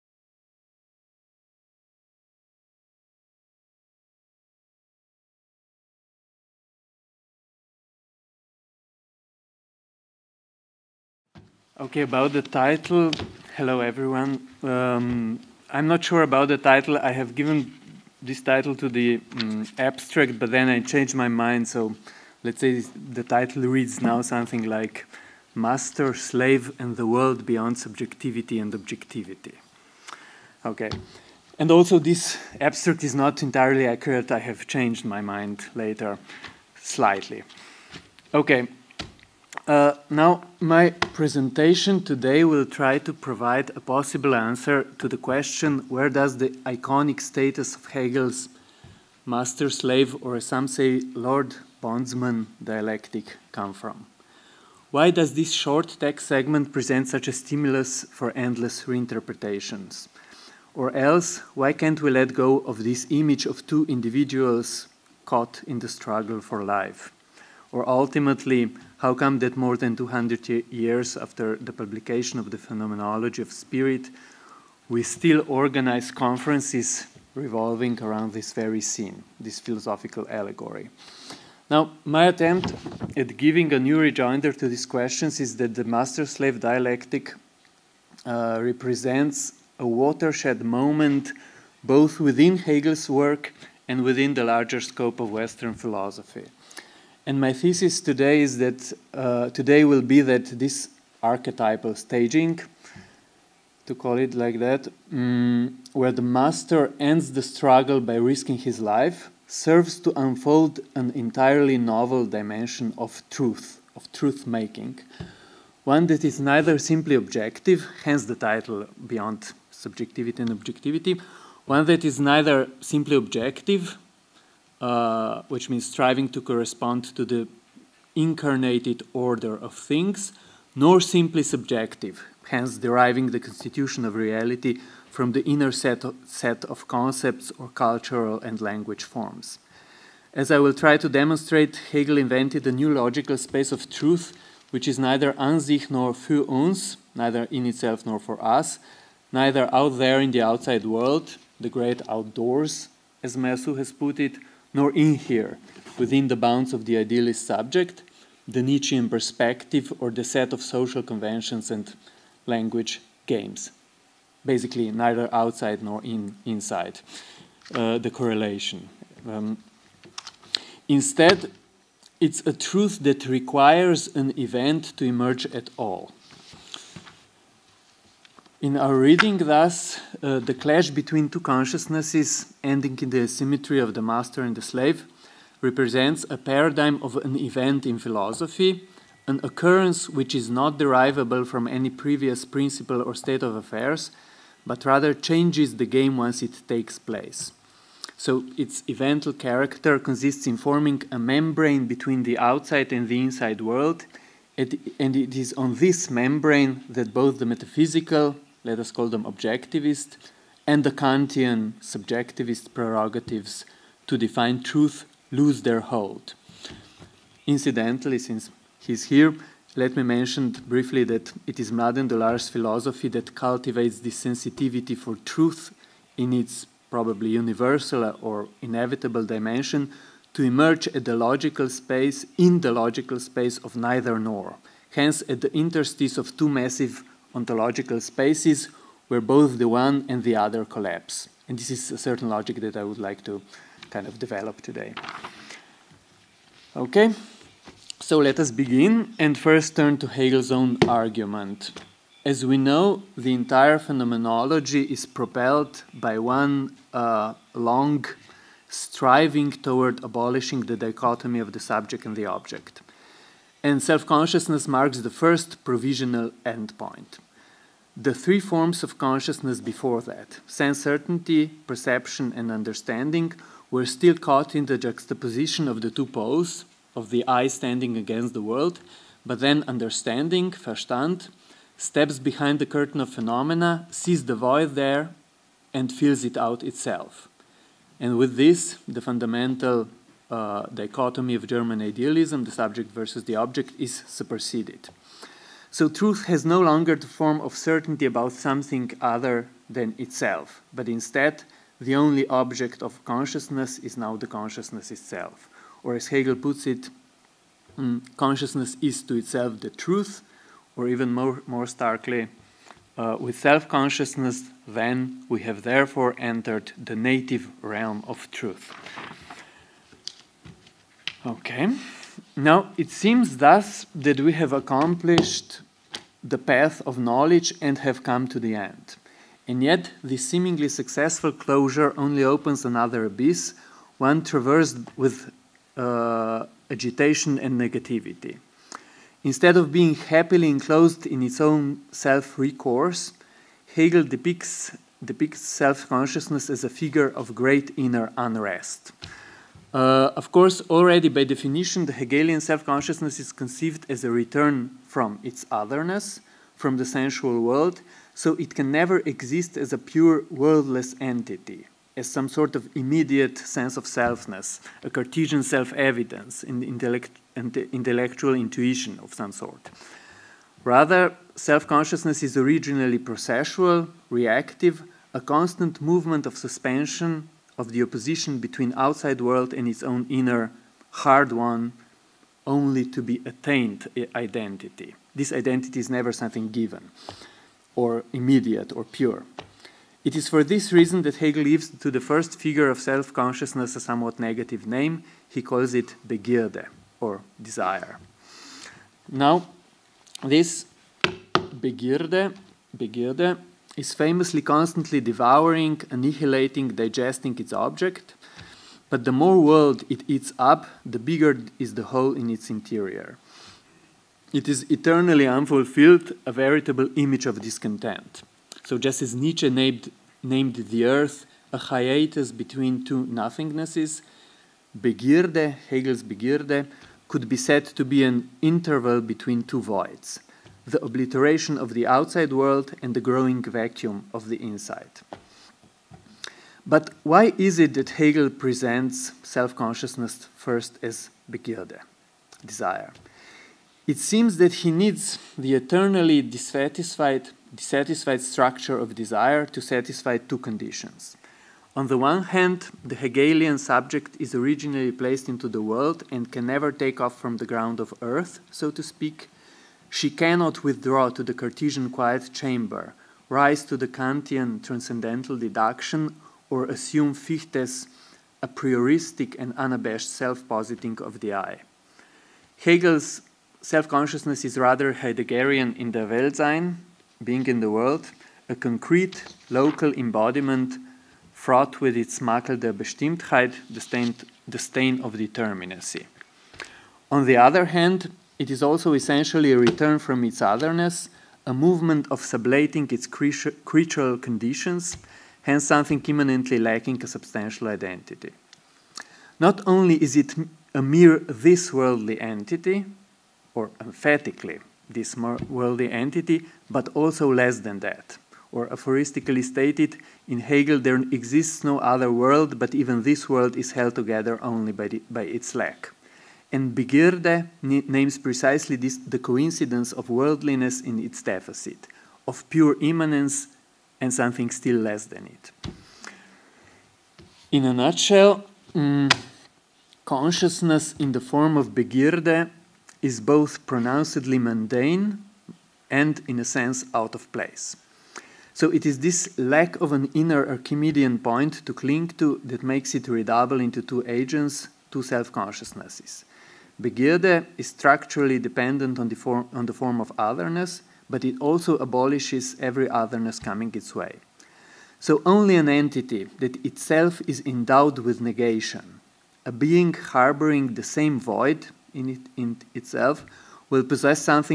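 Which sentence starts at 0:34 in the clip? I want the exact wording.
I have changed my mind later slightly.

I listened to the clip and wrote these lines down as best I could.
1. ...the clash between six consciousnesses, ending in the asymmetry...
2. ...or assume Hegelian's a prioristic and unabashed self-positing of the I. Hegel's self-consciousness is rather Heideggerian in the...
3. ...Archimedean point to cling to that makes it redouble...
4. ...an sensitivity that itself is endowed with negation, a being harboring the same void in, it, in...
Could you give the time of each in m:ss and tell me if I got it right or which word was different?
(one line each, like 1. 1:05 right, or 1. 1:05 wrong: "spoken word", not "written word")
1. 3:00 wrong: "two", not "six"
2. 7:46 wrong: "Fichte", not "Hegelian"
3. 9:00 right
4. 9:15 wrong: "entity", not "sensitivity".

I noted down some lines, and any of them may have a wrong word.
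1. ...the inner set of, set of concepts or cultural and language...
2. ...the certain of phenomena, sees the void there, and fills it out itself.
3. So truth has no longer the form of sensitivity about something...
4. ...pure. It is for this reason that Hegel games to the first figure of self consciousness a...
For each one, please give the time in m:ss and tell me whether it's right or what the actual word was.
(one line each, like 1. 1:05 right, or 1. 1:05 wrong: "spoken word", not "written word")
1. 2:15 right
2. 4:42 wrong: "curtain", not "certain"
3. 4:55 wrong: "certainty", not "sensitivity"
4. 6:28 wrong: "gives", not "games".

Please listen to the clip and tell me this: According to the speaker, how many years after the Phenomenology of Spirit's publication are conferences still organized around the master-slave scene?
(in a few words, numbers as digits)
more than 200.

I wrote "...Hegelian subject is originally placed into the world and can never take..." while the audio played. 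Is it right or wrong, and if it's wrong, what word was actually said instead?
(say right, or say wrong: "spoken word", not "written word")
right.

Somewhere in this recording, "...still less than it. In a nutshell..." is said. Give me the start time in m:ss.
8:44.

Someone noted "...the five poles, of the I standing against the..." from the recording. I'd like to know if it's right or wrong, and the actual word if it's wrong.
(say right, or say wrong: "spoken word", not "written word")
wrong: "two", not "five".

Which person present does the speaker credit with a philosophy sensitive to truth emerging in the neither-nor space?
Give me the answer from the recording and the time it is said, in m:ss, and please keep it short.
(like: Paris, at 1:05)
Mladen Dolar, at 3:41.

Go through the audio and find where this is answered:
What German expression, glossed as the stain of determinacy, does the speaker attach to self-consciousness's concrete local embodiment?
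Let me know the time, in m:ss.
8:02.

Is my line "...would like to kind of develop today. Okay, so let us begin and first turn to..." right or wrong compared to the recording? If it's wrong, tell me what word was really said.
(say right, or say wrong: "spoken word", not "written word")
right.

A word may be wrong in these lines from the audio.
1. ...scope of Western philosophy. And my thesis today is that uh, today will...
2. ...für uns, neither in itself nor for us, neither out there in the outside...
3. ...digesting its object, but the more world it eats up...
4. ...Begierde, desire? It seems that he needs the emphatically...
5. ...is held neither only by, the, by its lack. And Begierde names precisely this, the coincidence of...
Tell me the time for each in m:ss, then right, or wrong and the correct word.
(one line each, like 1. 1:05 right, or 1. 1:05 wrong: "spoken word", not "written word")
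1. 1:34 right
2. 2:26 right
3. 6:46 right
4. 7:21 wrong: "eternally", not "emphatically"
5. 8:33 wrong: "together", not "neither".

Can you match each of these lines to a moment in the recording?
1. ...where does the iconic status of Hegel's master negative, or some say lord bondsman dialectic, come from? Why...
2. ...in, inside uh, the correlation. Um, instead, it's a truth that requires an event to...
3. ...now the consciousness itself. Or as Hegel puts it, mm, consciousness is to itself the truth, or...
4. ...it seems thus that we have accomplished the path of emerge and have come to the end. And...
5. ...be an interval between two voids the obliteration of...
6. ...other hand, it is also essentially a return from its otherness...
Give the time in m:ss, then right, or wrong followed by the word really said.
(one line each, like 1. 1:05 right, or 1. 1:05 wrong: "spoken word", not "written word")
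1. 0:45 wrong: "slave", not "negative"
2. 2:46 right
3. 5:03 right
4. 5:22 wrong: "knowledge", not "emerge"
5. 7:07 right
6. 8:07 right.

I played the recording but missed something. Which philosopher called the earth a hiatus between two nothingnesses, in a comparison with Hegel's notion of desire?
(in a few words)
Nietzsche.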